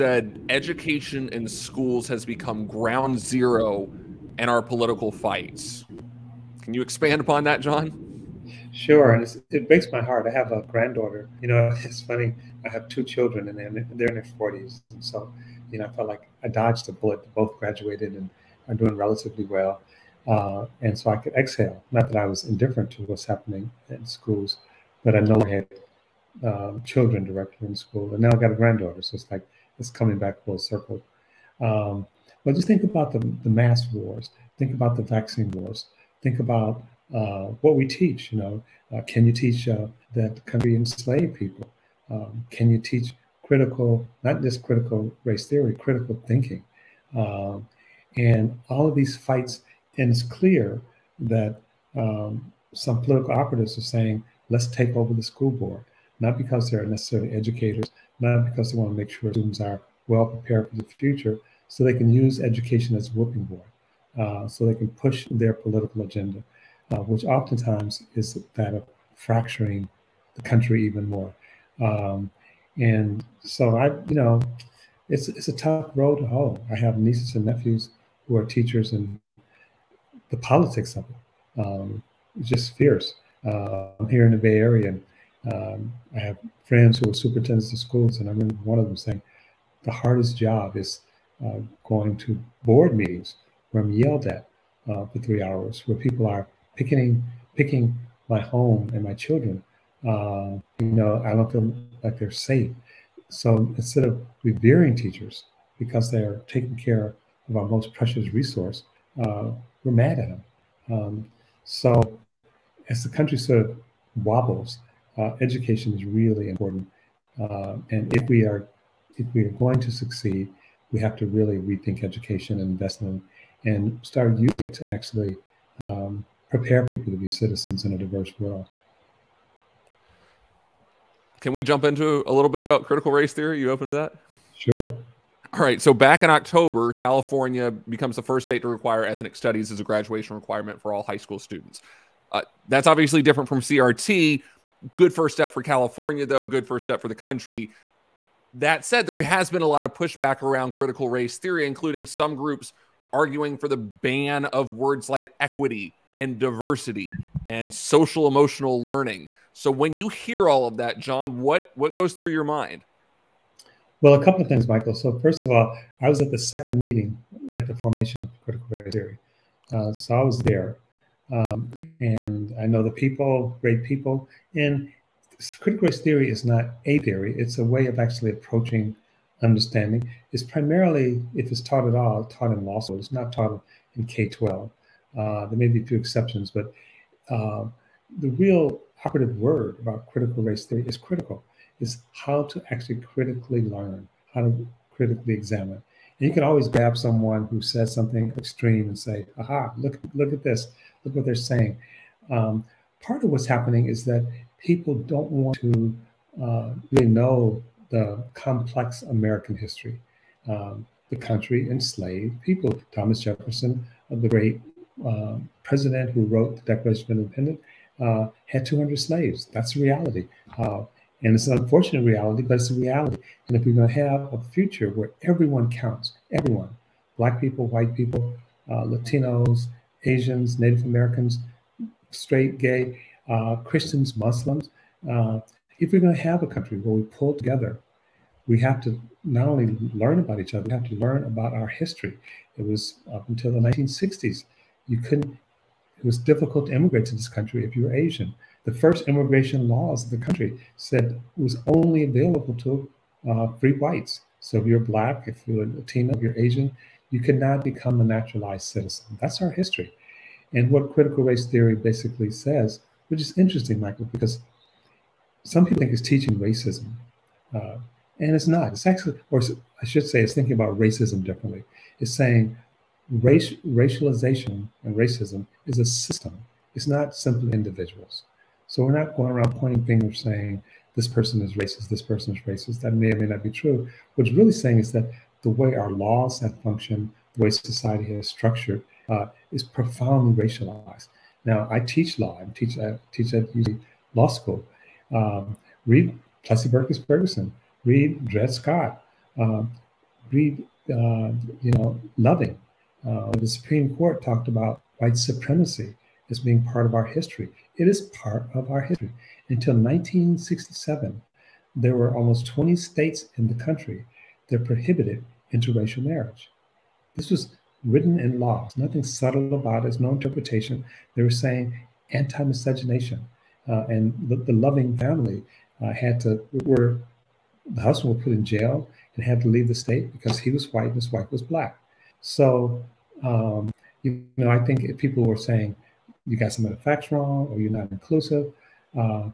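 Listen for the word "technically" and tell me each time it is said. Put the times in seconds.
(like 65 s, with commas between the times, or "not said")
not said.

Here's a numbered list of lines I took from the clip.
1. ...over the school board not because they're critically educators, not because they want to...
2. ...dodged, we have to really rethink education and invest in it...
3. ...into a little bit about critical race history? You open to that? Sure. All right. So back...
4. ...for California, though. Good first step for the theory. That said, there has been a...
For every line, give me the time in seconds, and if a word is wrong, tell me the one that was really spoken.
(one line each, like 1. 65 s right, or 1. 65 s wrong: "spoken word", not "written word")
1. 54 s wrong: "necessarily", not "critically"
2. 119 s wrong: "succeed", not "dodged"
3. 131 s wrong: "theory", not "history"
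4. 145 s wrong: "country", not "theory".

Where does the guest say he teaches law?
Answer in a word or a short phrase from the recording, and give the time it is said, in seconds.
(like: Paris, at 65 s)
UC Law School, at 293 s.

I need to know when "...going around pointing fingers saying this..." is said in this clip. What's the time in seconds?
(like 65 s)
279 s.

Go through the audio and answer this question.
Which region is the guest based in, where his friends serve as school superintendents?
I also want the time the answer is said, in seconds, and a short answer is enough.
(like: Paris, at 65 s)
Bay Area, at 84 s.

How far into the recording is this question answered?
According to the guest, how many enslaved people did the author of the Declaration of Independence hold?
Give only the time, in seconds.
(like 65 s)
218 s.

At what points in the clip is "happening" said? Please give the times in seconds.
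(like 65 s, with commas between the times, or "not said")
23 s, 203 s.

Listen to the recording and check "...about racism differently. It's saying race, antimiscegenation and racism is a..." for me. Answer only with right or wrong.
wrong.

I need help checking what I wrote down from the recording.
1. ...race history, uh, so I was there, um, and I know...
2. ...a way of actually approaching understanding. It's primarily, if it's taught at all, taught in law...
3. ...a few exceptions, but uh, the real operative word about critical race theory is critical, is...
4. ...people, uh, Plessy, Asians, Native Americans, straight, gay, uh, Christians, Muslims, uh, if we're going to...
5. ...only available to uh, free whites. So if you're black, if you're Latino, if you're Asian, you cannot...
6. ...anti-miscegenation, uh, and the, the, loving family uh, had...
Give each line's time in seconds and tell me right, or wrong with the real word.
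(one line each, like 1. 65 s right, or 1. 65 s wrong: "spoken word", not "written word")
1. 168 s wrong: "theory", not "history"
2. 177 s right
3. 185 s right
4. 227 s wrong: "Latinos", not "Plessy"
5. 251 s right
6. 322 s right.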